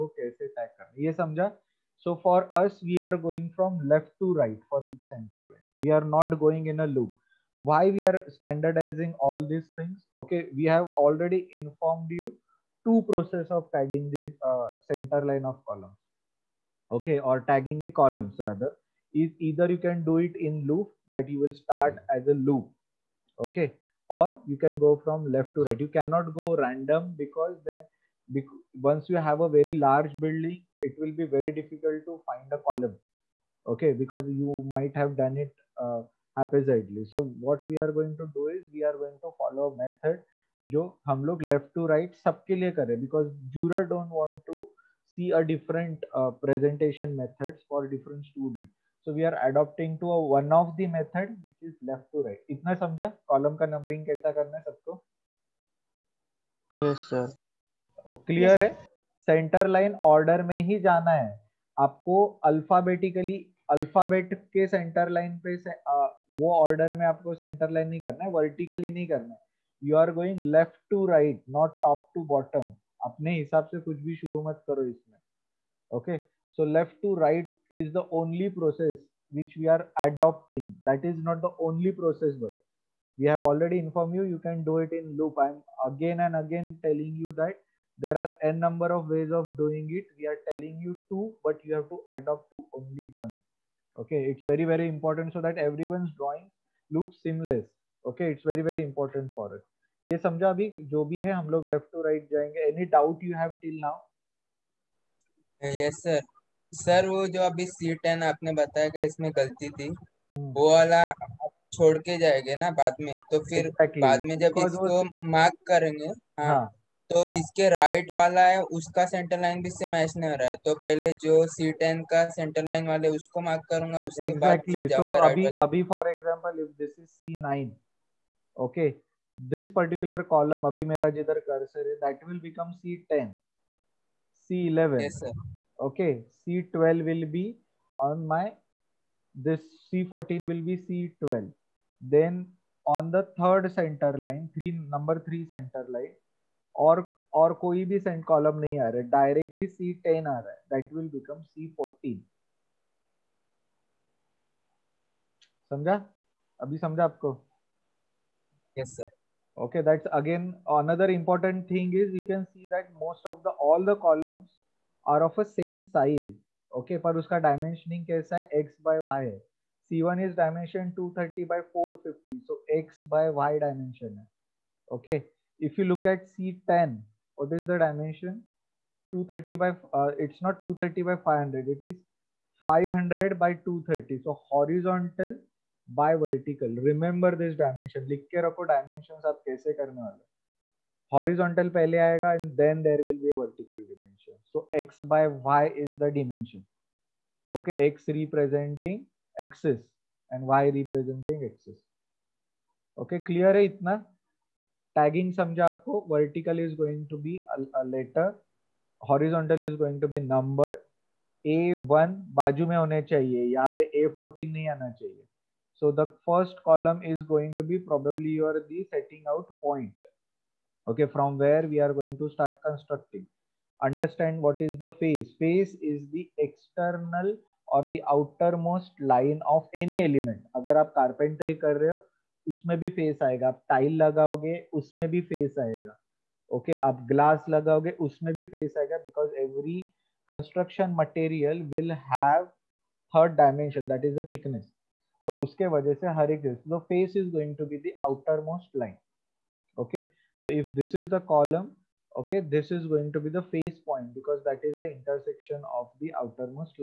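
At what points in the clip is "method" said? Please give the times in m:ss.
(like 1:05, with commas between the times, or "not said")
0:39, 0:50.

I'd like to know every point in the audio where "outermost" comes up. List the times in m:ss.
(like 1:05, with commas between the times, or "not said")
3:48, 4:16.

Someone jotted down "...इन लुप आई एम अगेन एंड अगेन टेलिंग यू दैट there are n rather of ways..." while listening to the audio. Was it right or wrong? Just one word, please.
wrong.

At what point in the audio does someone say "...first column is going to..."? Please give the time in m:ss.
3:36.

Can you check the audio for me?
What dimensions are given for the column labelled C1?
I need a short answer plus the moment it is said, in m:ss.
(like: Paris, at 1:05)
230 by 450, at 2:50.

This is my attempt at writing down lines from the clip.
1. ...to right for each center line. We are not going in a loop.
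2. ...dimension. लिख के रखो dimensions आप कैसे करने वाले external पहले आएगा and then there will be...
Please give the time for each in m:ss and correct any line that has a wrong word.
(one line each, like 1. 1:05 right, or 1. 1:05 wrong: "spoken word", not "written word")
1. 0:04 right
2. 3:07 wrong: "horizontal", not "external".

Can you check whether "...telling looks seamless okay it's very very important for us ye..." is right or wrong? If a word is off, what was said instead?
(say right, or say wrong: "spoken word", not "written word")
wrong: "drawing", not "telling".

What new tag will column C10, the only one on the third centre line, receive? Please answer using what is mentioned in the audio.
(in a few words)
C14.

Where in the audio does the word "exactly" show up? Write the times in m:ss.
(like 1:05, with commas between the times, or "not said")
1:53, 2:04.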